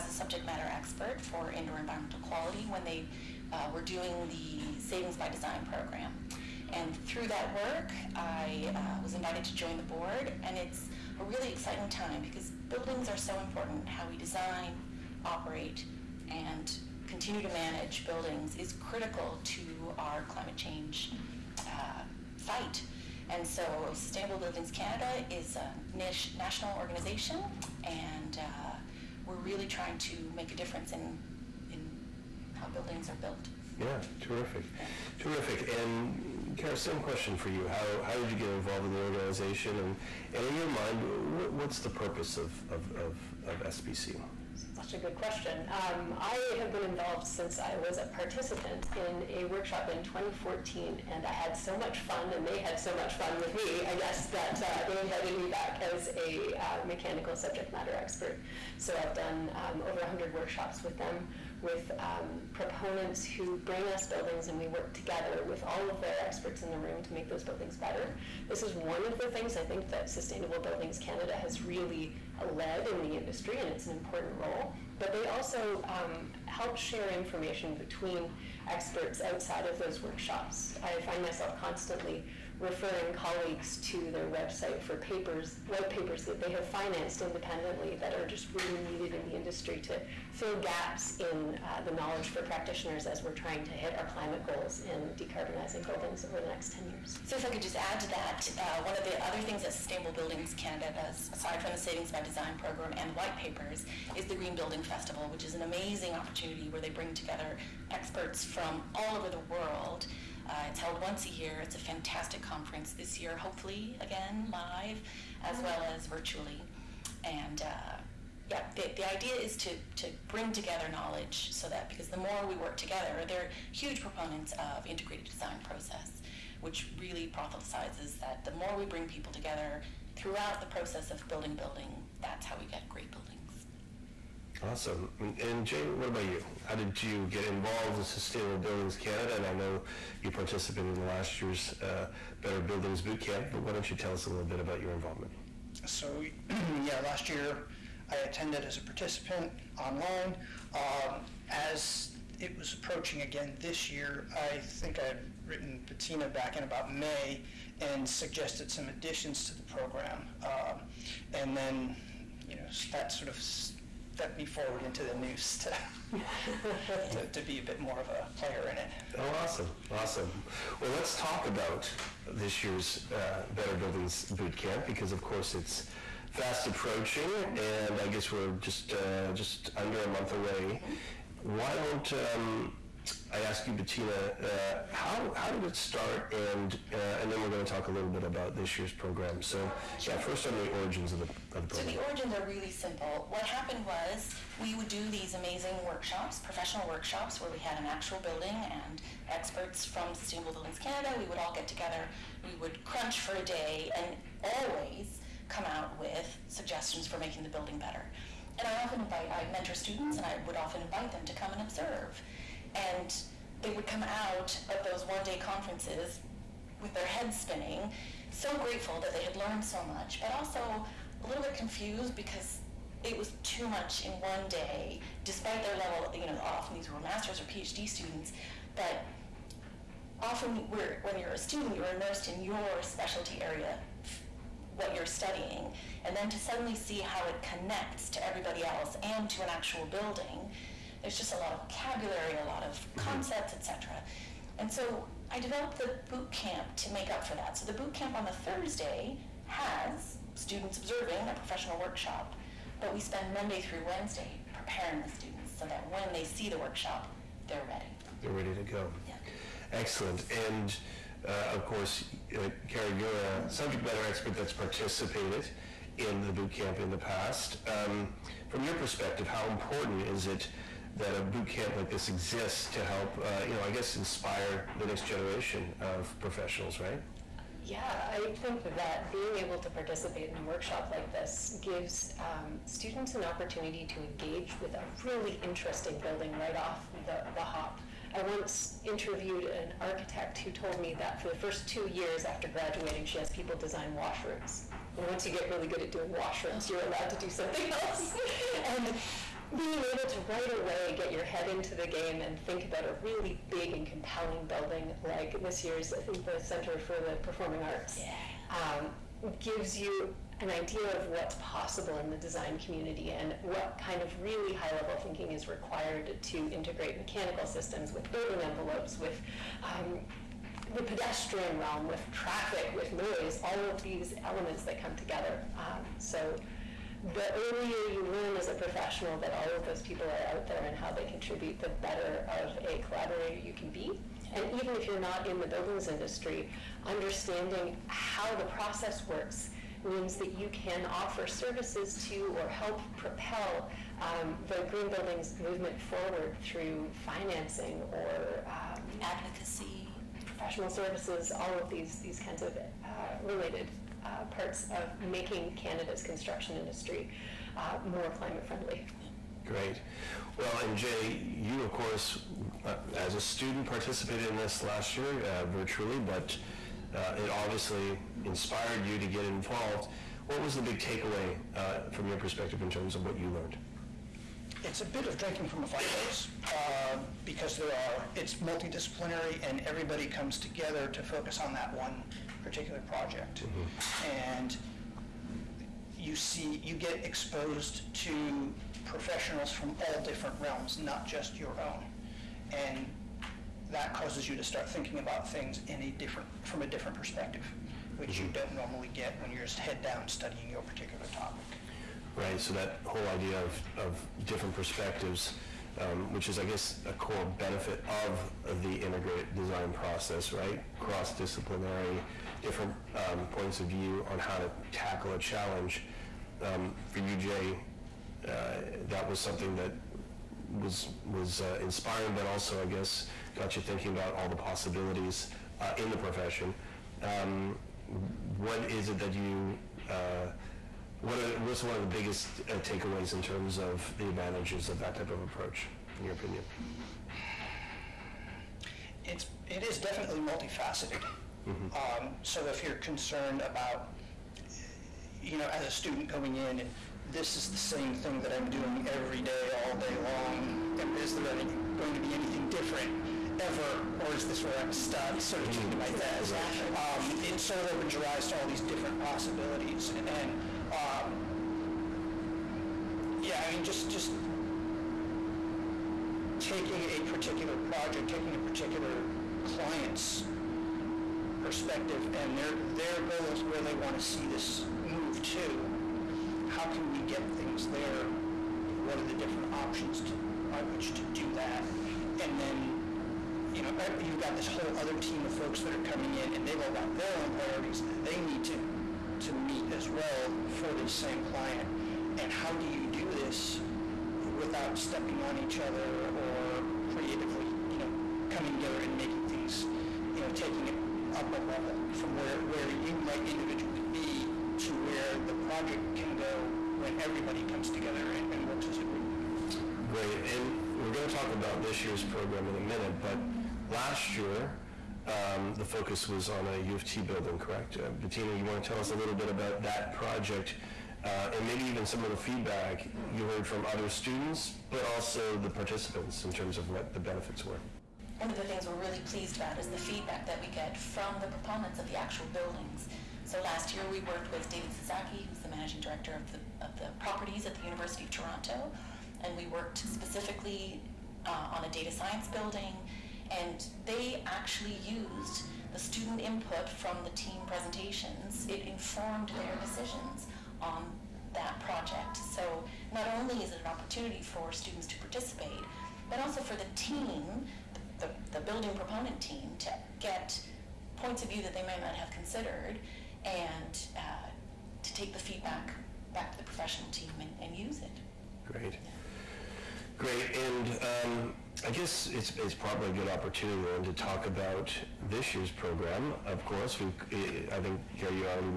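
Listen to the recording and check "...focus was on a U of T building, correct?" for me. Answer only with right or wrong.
right.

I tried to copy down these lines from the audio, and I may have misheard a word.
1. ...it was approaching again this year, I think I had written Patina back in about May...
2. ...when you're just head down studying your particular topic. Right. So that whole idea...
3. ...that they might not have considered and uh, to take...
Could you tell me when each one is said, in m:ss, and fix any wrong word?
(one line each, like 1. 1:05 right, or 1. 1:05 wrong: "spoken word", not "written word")
1. 2:32 right
2. 6:39 right
3. 9:21 right.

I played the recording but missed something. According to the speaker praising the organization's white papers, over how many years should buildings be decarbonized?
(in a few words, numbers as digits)
10 years.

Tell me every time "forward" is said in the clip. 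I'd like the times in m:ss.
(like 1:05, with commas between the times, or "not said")
2:44, 5:45.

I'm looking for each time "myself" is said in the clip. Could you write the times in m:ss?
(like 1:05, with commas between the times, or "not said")
1:21.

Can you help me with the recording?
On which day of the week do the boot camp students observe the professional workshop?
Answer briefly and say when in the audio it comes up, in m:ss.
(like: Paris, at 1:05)
Thursday, at 4:08.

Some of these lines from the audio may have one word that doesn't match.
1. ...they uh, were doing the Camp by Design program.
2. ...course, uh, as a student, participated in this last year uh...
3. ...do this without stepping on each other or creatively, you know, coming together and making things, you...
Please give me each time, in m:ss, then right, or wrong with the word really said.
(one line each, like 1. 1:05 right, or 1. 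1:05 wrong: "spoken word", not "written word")
1. 0:02 wrong: "Savings", not "Camp"
2. 6:01 right
3. 8:12 right.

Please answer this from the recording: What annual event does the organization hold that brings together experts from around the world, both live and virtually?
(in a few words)
Green Building Festival.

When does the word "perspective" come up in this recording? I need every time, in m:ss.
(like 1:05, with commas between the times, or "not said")
4:28, 6:12, 6:36, 6:44, 7:51.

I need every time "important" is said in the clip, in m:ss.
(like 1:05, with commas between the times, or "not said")
0:13, 1:13, 4:29.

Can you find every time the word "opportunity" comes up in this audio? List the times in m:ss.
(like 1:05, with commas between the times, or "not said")
1:46, 4:43, 9:13, 9:33.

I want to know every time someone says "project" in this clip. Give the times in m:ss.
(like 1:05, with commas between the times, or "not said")
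6:22, 7:47, 8:25, 8:39, 9:11.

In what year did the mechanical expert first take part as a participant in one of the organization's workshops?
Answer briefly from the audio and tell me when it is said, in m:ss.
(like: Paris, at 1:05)
2014, at 0:50.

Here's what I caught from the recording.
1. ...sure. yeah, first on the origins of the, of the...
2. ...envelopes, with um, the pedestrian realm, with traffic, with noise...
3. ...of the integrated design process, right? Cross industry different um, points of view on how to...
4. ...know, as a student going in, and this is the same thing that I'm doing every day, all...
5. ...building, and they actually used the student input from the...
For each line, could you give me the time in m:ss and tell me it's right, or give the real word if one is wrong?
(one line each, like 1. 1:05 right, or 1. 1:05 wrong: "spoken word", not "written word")
1. 3:09 right
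2. 5:18 right
3. 6:47 wrong: "disciplinary", not "industry"
4. 7:25 right
5. 9:02 right.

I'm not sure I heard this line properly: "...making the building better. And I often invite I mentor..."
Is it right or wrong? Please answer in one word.
right.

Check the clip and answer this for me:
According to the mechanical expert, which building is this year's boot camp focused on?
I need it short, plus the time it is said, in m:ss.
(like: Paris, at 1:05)
Center for the Performing Arts, at 5:06.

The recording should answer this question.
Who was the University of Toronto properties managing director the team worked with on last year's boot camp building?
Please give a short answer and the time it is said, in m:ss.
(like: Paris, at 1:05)
David Sasaki, at 8:54.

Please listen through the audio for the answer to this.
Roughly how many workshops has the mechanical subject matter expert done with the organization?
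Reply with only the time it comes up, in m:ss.
0:59.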